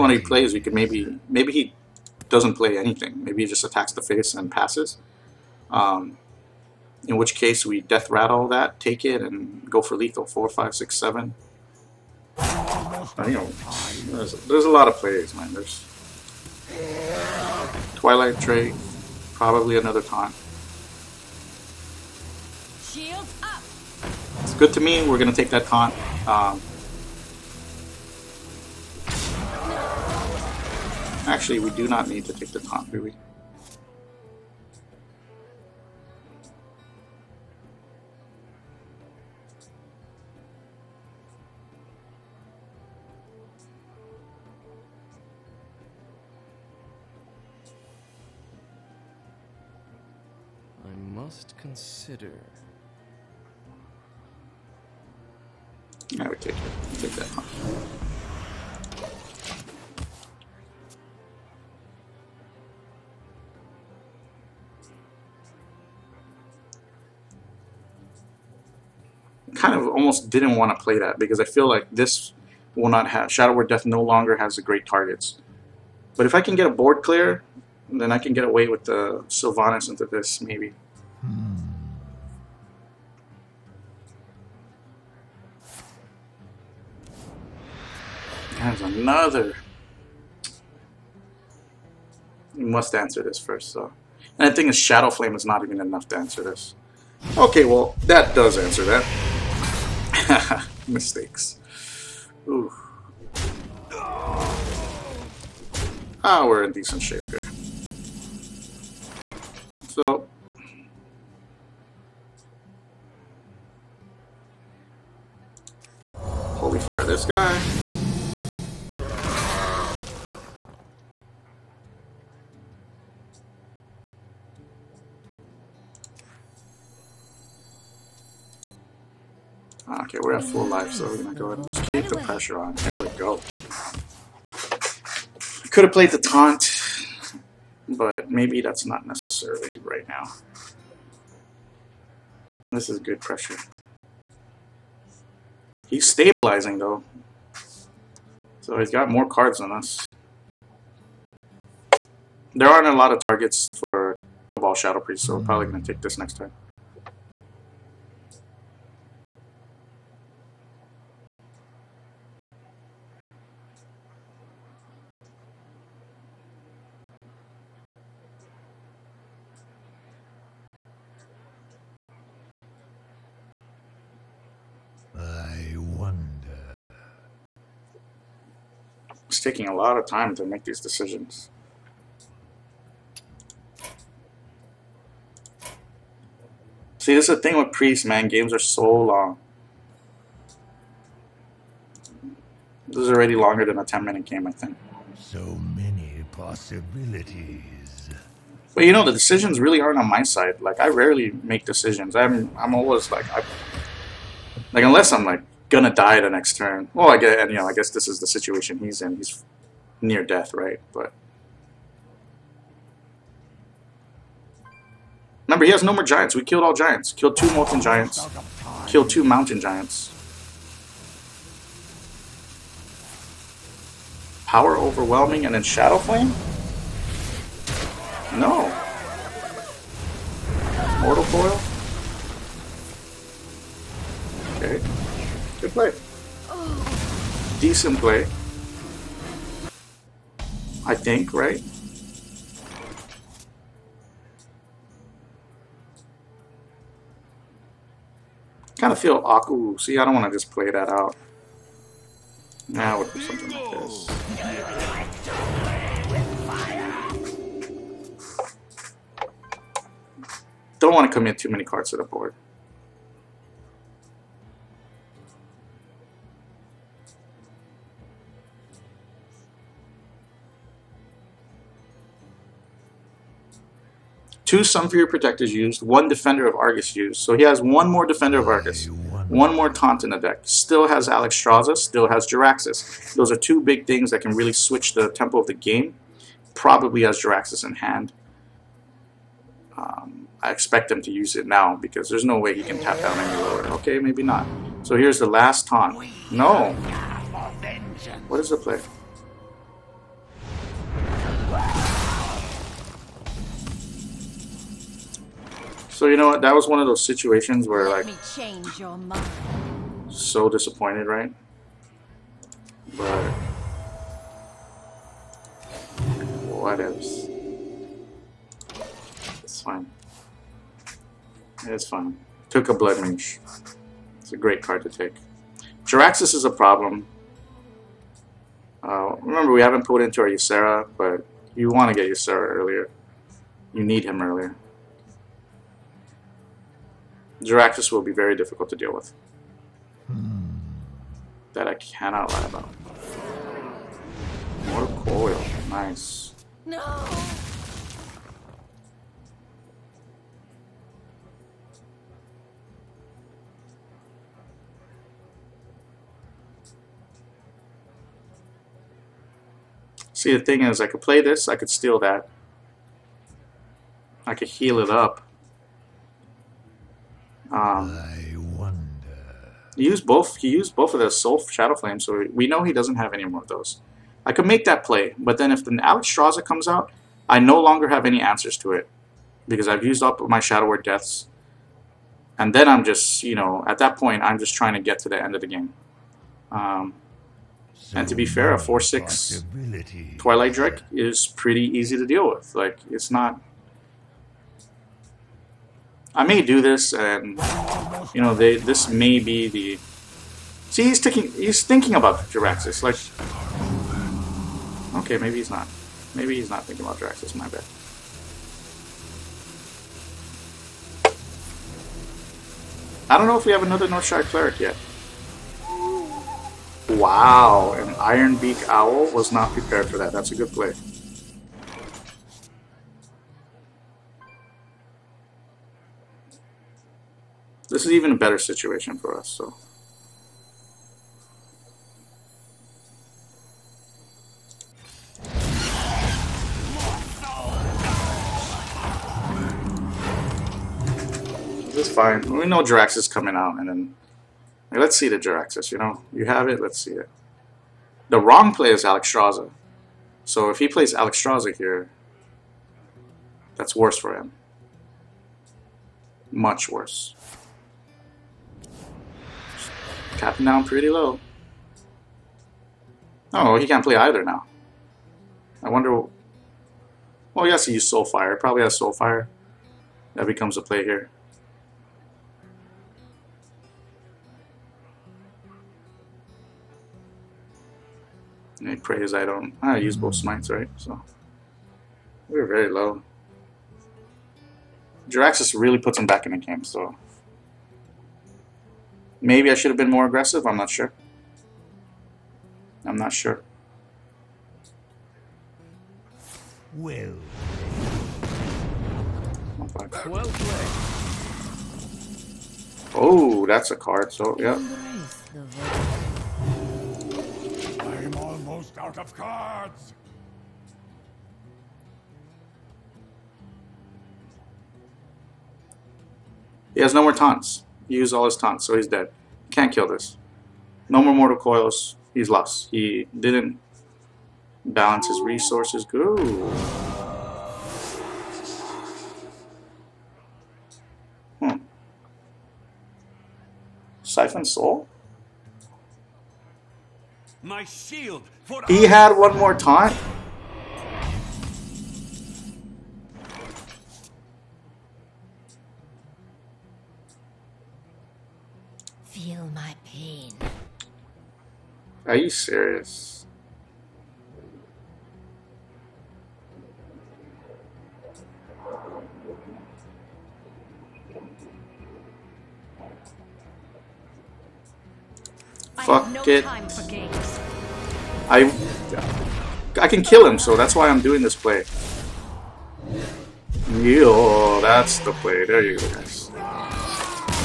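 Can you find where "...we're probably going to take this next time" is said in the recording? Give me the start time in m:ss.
2:35.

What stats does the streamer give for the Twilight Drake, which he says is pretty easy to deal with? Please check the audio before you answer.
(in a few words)
4/6.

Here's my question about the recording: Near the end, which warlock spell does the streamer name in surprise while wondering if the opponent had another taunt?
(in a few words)
Siphon Soul.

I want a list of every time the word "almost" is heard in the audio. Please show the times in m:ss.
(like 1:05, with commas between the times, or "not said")
1:09, 8:28.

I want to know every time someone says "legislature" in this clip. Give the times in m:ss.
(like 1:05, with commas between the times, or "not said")
not said.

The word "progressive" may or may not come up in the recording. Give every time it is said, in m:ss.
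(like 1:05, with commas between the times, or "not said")
not said.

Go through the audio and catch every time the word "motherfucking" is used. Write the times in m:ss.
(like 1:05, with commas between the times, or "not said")
not said.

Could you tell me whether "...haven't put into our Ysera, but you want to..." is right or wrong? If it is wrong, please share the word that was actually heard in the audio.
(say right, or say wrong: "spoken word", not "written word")
right.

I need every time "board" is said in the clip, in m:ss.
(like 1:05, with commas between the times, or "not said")
1:16, 4:22.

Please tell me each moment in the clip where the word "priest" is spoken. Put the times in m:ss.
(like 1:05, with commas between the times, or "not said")
2:34, 3:07.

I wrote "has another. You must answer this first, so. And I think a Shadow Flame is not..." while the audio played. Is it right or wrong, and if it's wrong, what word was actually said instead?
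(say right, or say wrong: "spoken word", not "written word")
right.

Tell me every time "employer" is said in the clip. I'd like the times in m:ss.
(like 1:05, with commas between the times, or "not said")
not said.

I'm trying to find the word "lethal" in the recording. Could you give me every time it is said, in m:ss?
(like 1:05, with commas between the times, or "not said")
0:09.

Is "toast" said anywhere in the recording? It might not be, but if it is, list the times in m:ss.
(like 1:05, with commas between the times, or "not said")
not said.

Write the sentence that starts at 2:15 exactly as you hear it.
Could have played the taunt, but maybe that's not necessary right now.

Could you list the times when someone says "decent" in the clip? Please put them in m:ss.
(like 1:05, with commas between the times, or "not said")
1:46, 3:57.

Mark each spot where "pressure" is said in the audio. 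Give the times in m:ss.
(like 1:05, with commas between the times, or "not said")
2:12, 2:23.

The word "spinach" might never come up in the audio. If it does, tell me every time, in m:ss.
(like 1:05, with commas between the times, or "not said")
not said.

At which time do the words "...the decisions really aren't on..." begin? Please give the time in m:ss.
3:19.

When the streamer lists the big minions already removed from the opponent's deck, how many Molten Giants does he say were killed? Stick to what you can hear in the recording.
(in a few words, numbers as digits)
2.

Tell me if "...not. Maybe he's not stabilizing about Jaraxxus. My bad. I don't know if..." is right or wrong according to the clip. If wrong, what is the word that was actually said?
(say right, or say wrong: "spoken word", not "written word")
wrong: "thinking", not "stabilizing".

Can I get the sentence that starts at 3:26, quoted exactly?
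Well, I get, and you know, I guess this is the situation he's in.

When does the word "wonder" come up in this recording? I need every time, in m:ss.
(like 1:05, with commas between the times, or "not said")
6:08, 7:45.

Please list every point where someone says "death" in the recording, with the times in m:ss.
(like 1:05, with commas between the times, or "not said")
0:07, 1:13, 3:30, 6:20.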